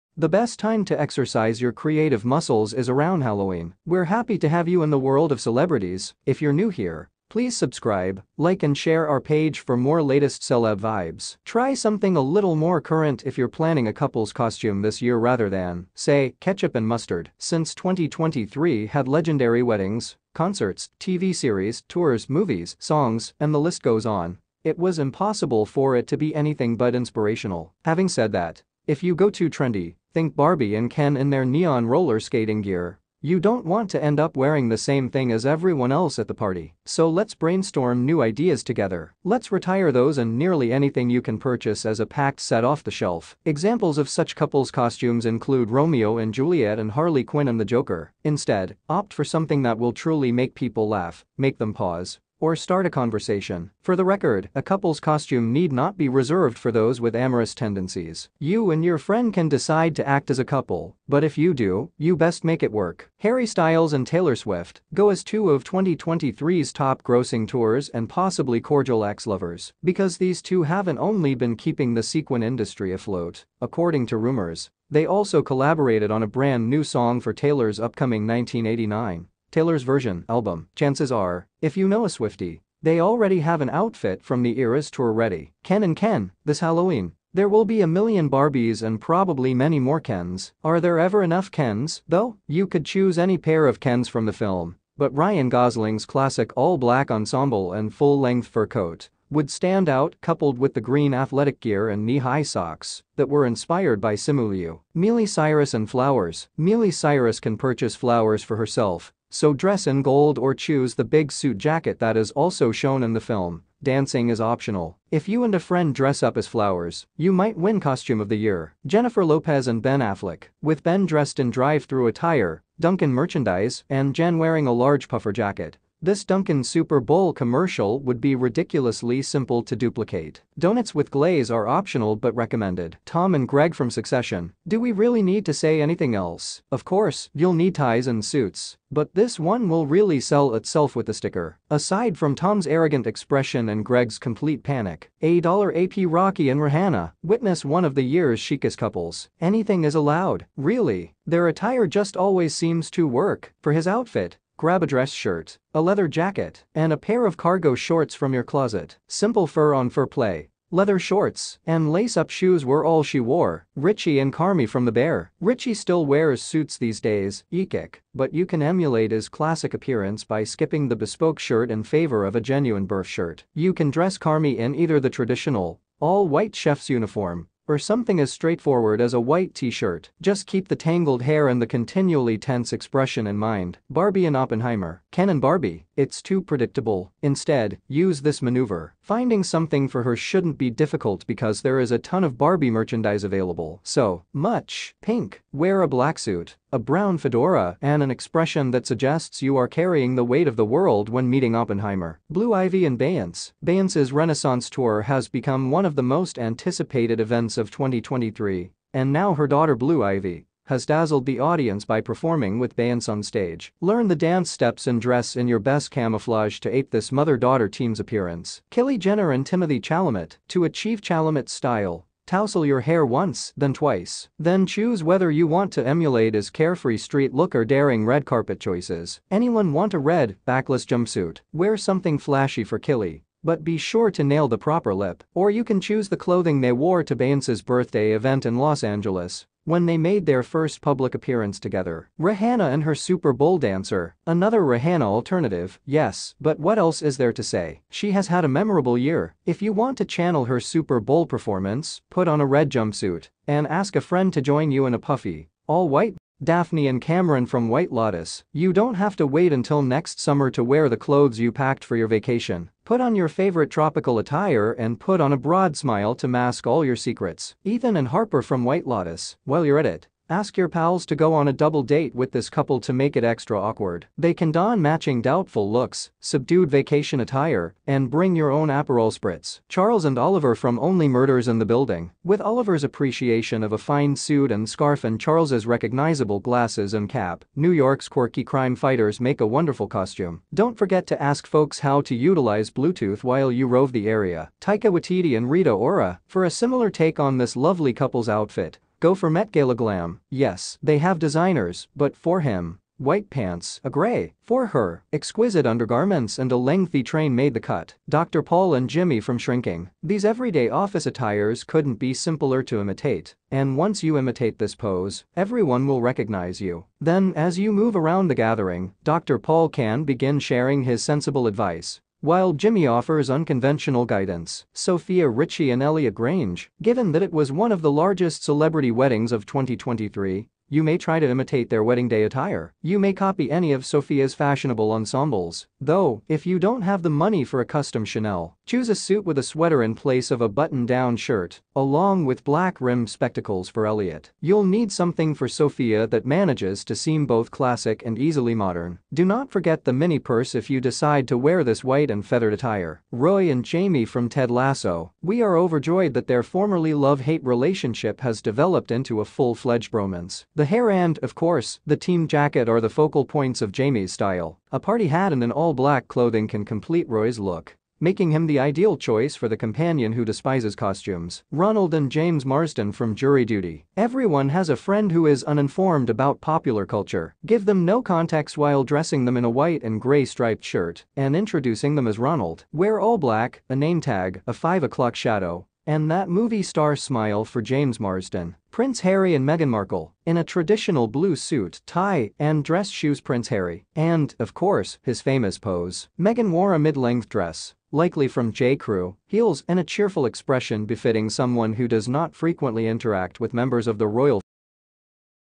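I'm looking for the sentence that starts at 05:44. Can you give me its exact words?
You'll need something for Sofia that manages to seem both classic and easily modern.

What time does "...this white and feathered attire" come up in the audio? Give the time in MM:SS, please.
05:51.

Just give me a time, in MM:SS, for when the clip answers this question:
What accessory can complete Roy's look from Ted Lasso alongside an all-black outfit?
06:04.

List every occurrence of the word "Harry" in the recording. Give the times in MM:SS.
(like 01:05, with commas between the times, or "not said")
01:03, 06:28, 06:33.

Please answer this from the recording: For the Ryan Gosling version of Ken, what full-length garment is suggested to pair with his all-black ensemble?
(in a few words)
fur coat.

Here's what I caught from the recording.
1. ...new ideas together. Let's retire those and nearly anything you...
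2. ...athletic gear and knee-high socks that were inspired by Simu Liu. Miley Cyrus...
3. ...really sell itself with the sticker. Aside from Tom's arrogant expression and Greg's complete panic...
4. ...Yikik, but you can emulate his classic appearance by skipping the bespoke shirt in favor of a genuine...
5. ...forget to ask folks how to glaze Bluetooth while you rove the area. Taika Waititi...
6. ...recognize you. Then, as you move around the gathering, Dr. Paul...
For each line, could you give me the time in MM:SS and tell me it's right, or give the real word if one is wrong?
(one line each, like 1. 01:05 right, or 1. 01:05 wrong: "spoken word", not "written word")
1. 00:38 right
2. 01:41 right
3. 02:19 right
4. 02:47 right
5. 04:50 wrong: "utilize", not "glaze"
6. 05:16 right.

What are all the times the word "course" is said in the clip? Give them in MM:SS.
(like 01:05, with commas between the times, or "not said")
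02:16, 06:01, 06:34.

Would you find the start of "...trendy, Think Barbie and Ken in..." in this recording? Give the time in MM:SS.
00:29.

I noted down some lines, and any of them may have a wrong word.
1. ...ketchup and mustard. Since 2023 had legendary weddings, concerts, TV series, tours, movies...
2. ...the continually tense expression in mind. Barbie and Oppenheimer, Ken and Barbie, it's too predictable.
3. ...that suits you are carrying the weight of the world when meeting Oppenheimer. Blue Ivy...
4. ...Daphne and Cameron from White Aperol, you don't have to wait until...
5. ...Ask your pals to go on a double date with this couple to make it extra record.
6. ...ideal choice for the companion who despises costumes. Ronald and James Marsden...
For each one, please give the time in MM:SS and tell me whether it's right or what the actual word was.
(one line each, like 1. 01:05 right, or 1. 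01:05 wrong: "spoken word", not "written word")
1. 00:16 right
2. 03:01 right
3. 03:18 wrong: "suggests", not "suits"
4. 04:16 wrong: "Lotus", not "Aperol"
5. 04:30 wrong: "awkward", not "record"
6. 06:08 right.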